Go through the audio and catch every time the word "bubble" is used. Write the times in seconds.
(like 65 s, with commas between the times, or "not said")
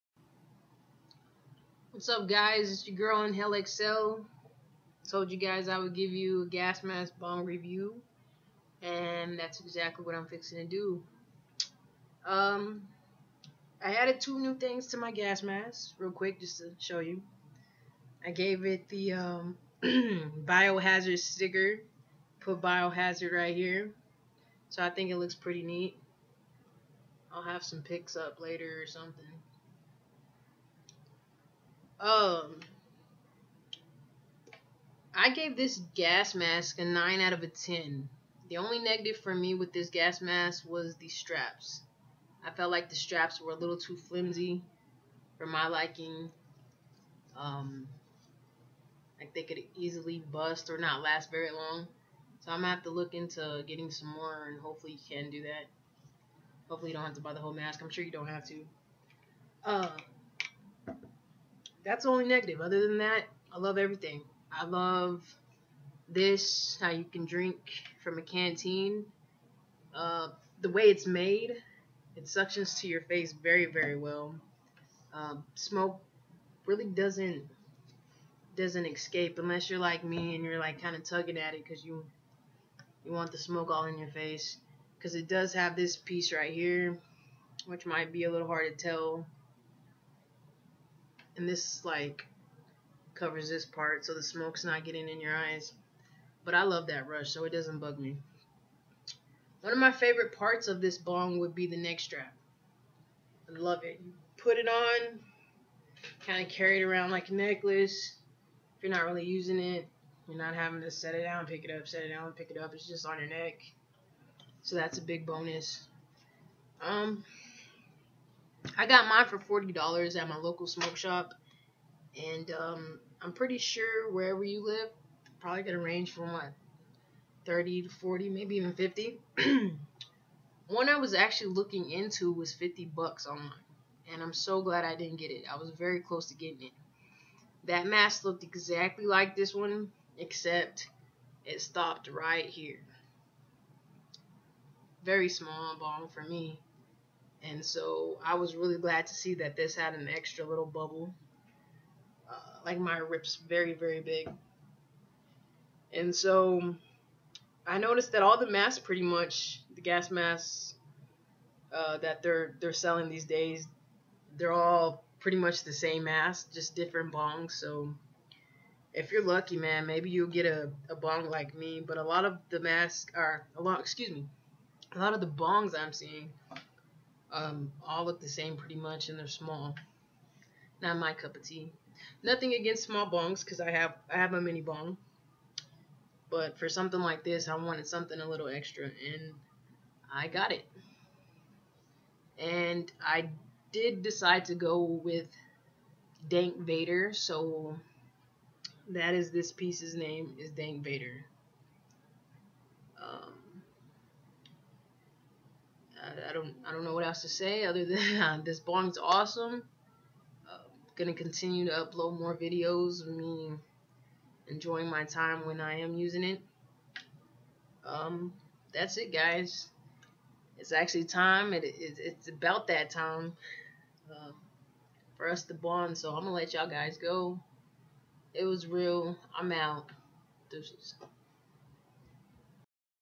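150 s.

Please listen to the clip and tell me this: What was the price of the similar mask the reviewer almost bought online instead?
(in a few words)
$50.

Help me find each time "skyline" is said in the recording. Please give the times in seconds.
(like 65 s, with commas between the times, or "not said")
not said.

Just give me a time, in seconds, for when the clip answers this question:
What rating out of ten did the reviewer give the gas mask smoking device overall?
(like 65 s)
36 s.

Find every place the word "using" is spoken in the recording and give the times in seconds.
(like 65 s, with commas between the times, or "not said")
109 s, 215 s.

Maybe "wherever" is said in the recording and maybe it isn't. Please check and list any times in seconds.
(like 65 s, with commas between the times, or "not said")
124 s.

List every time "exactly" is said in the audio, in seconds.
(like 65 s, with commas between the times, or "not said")
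9 s, 138 s.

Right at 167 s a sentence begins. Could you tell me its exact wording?
So if you're lucky, man, maybe you'll get a, a bong like me.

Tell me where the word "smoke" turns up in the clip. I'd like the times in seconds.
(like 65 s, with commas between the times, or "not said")
75 s, 83 s, 94 s, 120 s.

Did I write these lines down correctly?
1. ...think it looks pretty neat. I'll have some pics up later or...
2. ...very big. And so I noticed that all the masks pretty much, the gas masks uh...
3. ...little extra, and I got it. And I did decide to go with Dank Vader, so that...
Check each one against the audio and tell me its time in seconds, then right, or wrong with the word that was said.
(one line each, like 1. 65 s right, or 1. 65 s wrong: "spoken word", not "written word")
1. 24 s right
2. 153 s right
3. 188 s right.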